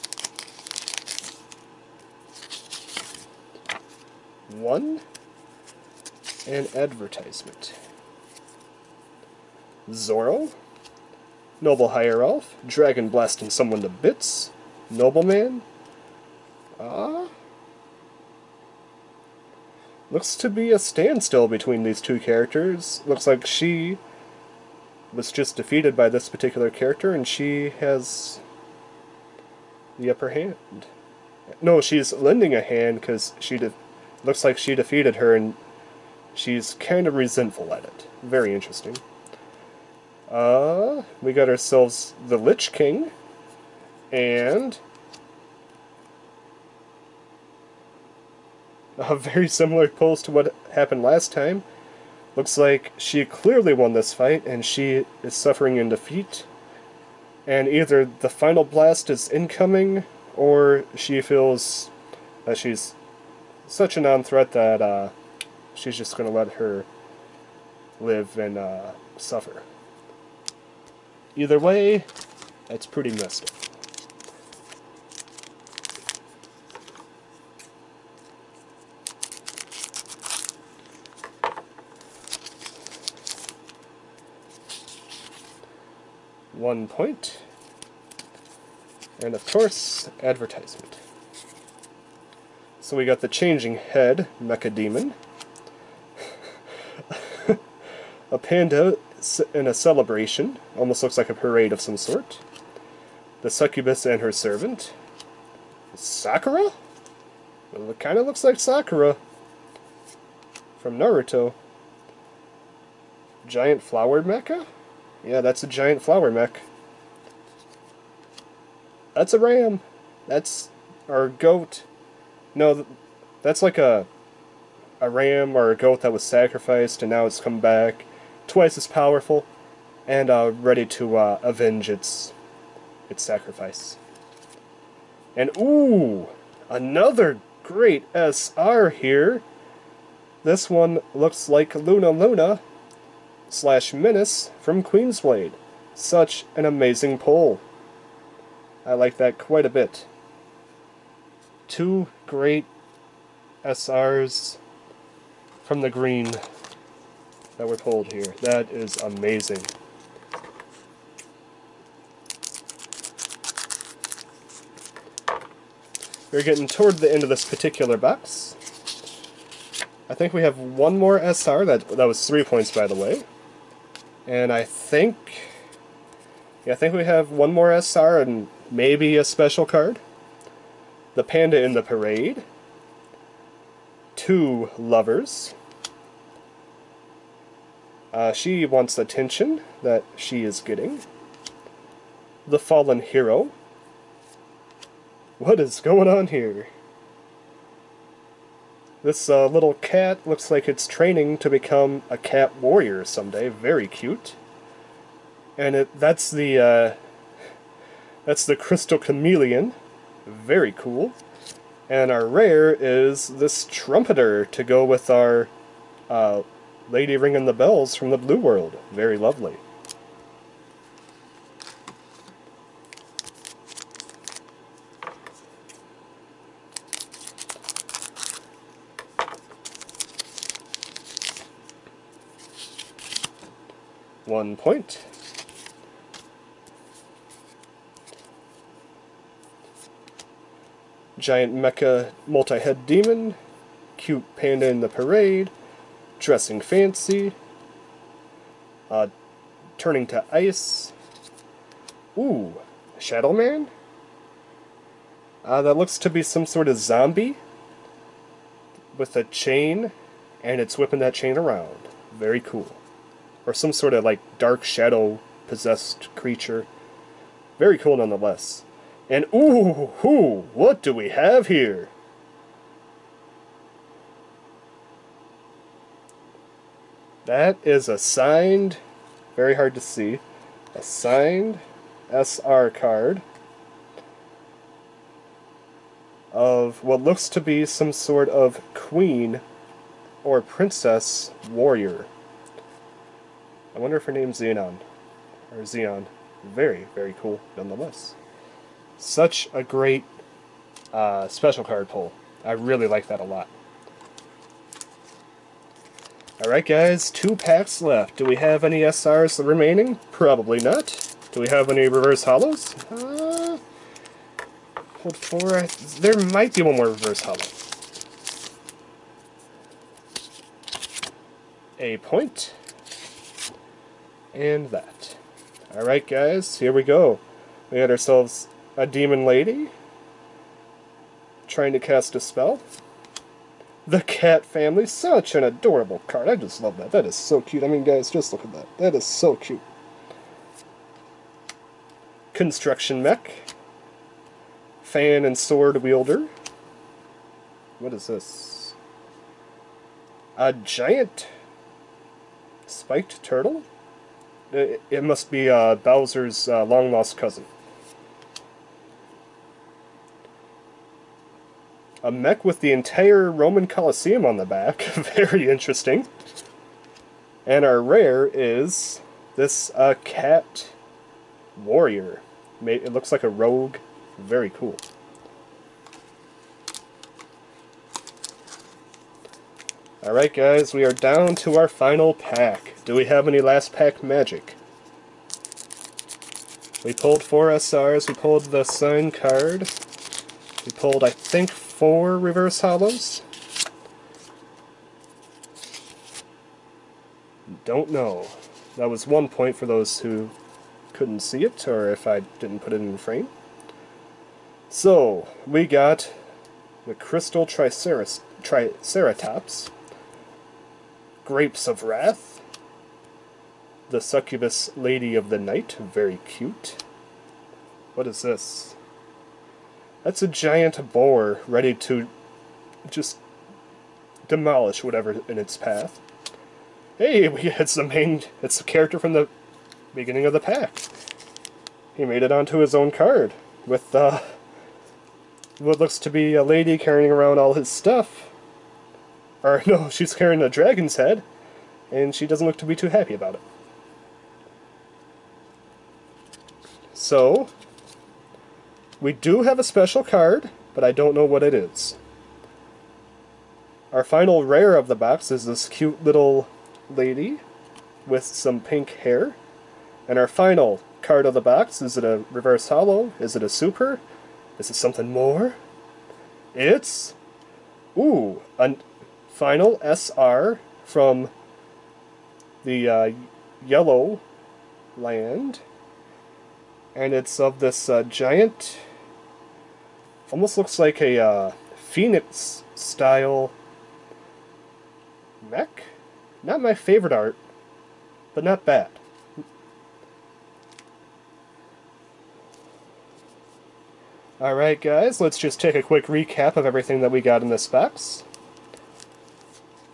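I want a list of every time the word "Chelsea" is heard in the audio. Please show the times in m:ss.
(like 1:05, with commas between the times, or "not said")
not said.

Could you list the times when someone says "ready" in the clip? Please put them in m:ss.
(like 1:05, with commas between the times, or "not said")
2:10, 7:01.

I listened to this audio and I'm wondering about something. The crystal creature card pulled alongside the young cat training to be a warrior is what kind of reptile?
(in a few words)
chameleon.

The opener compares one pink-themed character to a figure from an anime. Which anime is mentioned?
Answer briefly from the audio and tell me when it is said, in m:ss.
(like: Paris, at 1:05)
Naruto, at 1:50.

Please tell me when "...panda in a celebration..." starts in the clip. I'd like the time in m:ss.
1:38.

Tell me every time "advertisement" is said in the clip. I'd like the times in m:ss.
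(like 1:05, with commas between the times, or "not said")
0:06, 1:30.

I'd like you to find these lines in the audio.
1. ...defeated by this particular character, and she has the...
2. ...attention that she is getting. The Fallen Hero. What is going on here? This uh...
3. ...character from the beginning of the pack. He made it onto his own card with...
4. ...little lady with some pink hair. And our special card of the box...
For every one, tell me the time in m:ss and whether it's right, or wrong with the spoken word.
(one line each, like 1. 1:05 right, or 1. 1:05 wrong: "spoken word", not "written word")
1. 0:25 right
2. 3:08 right
3. 7:08 right
4. 7:36 wrong: "final", not "special".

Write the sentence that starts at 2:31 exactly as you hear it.
Two great SRs from the green that were pulled here.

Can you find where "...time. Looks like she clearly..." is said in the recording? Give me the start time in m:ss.
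0:51.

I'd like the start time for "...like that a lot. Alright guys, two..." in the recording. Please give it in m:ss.
5:02.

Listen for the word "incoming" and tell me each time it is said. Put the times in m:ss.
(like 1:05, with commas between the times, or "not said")
0:59.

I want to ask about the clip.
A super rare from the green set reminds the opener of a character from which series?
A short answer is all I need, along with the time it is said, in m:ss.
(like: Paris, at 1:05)
Queensblade, at 2:24.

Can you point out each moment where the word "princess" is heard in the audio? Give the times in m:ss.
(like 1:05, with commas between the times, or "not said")
4:50.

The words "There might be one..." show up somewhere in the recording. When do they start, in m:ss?
5:15.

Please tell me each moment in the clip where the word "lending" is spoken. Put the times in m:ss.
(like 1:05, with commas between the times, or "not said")
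0:32.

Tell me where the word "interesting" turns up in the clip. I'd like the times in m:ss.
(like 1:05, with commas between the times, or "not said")
0:38, 6:05.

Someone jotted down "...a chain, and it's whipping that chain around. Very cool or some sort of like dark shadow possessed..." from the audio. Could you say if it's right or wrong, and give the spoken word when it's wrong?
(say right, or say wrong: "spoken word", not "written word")
right.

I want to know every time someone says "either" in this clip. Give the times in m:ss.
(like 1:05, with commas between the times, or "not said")
0:57, 1:11.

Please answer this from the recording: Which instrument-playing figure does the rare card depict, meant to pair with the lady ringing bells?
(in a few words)
trumpeter.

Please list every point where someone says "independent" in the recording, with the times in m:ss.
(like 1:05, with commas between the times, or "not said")
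not said.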